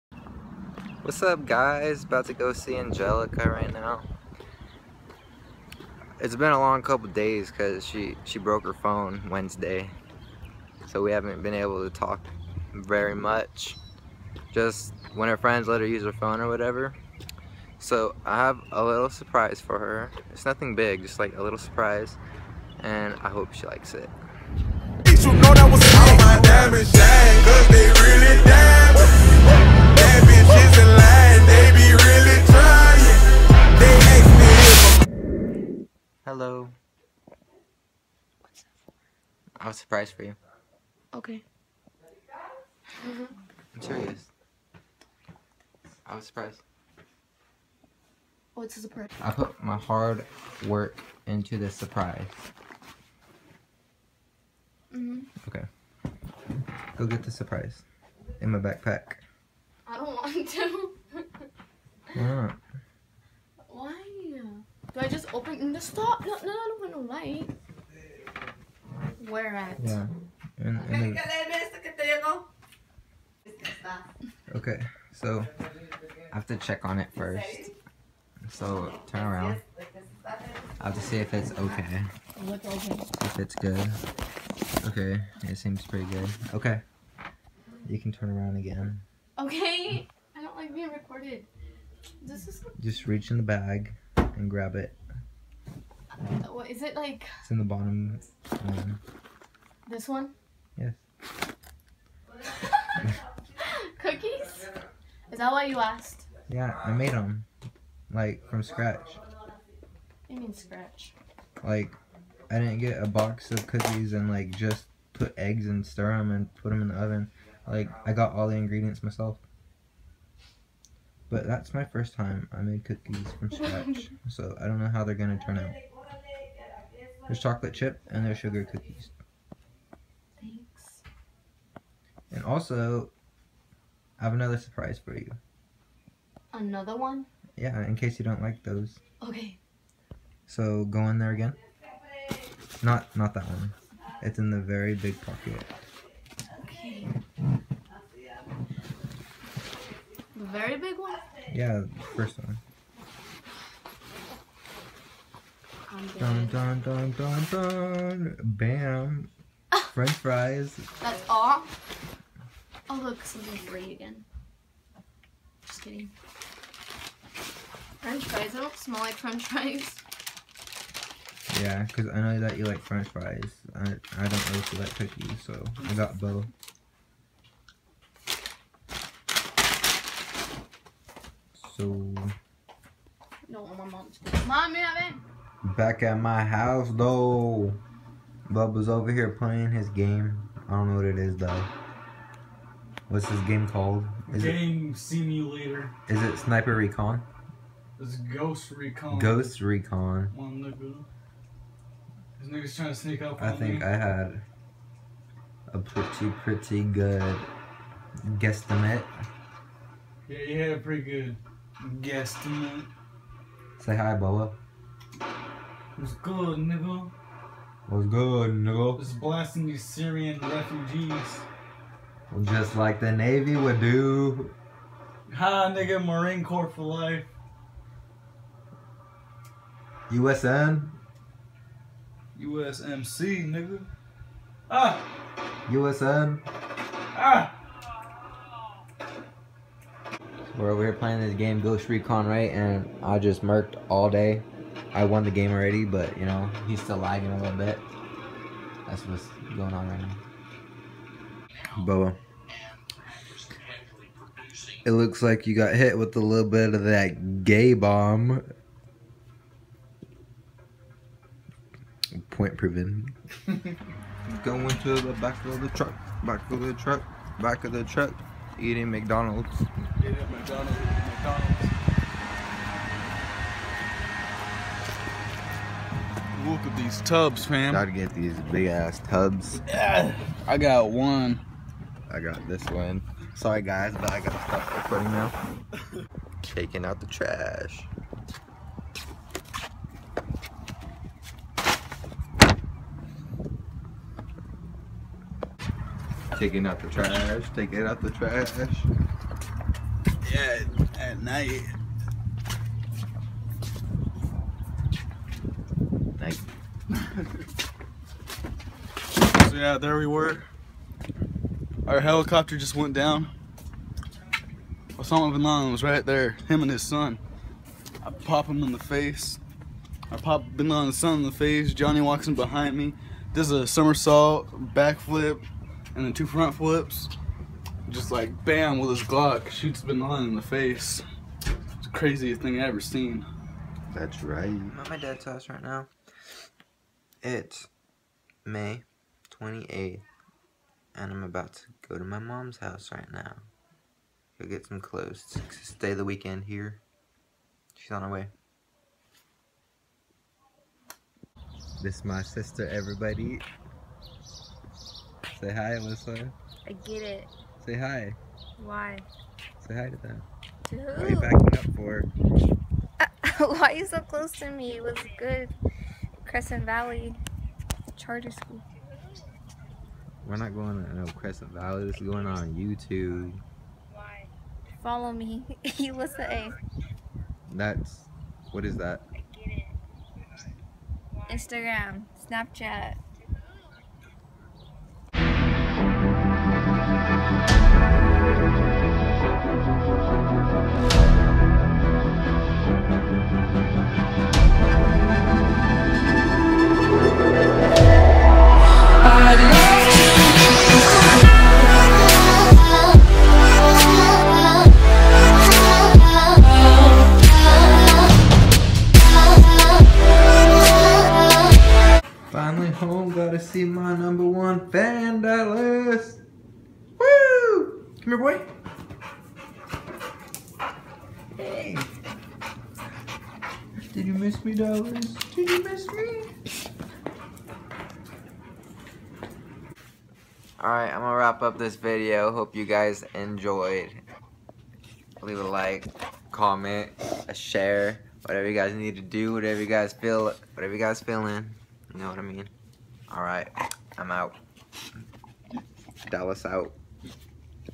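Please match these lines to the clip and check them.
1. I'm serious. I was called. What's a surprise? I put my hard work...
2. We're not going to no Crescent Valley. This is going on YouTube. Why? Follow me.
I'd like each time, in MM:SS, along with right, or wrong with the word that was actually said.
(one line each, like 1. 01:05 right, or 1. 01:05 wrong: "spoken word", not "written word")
1. 00:43 wrong: "surprised", not "called"
2. 06:10 right.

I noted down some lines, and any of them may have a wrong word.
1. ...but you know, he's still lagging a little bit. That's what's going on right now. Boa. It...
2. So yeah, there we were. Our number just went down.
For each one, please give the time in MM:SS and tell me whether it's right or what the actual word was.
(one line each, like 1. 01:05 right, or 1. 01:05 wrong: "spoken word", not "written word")
1. 04:05 right
2. 05:09 wrong: "helicopter", not "number".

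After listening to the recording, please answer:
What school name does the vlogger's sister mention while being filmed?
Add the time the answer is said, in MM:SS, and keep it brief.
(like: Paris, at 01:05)
Crescent Valley Charter School, at 06:06.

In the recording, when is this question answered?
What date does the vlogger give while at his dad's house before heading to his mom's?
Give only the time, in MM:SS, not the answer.
05:38.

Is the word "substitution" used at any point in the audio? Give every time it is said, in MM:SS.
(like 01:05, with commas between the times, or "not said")
not said.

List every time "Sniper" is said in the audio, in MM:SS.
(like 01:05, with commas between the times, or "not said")
03:16.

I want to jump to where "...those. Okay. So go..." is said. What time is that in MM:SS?
02:18.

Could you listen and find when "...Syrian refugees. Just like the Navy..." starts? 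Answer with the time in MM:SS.
03:39.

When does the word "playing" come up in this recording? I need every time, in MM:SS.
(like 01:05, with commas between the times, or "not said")
03:09, 04:00.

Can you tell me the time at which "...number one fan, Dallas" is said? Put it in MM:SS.
06:53.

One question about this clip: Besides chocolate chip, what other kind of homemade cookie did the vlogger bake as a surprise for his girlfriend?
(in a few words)
Sugar cookies.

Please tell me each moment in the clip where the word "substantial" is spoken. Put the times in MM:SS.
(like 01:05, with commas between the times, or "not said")
not said.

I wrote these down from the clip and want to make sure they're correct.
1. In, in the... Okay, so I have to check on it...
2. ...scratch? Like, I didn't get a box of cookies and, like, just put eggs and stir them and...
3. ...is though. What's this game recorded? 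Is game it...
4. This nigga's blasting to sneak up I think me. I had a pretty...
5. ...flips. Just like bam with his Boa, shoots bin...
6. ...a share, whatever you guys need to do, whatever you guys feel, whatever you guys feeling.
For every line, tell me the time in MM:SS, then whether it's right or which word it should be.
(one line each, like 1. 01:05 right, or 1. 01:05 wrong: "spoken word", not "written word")
1. 01:10 right
2. 01:50 right
3. 03:11 wrong: "called", not "recorded"
4. 03:22 wrong: "trying", not "blasting"
5. 05:26 wrong: "Glock", not "Boa"
6. 07:17 right.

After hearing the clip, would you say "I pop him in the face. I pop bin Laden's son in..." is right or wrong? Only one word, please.
right.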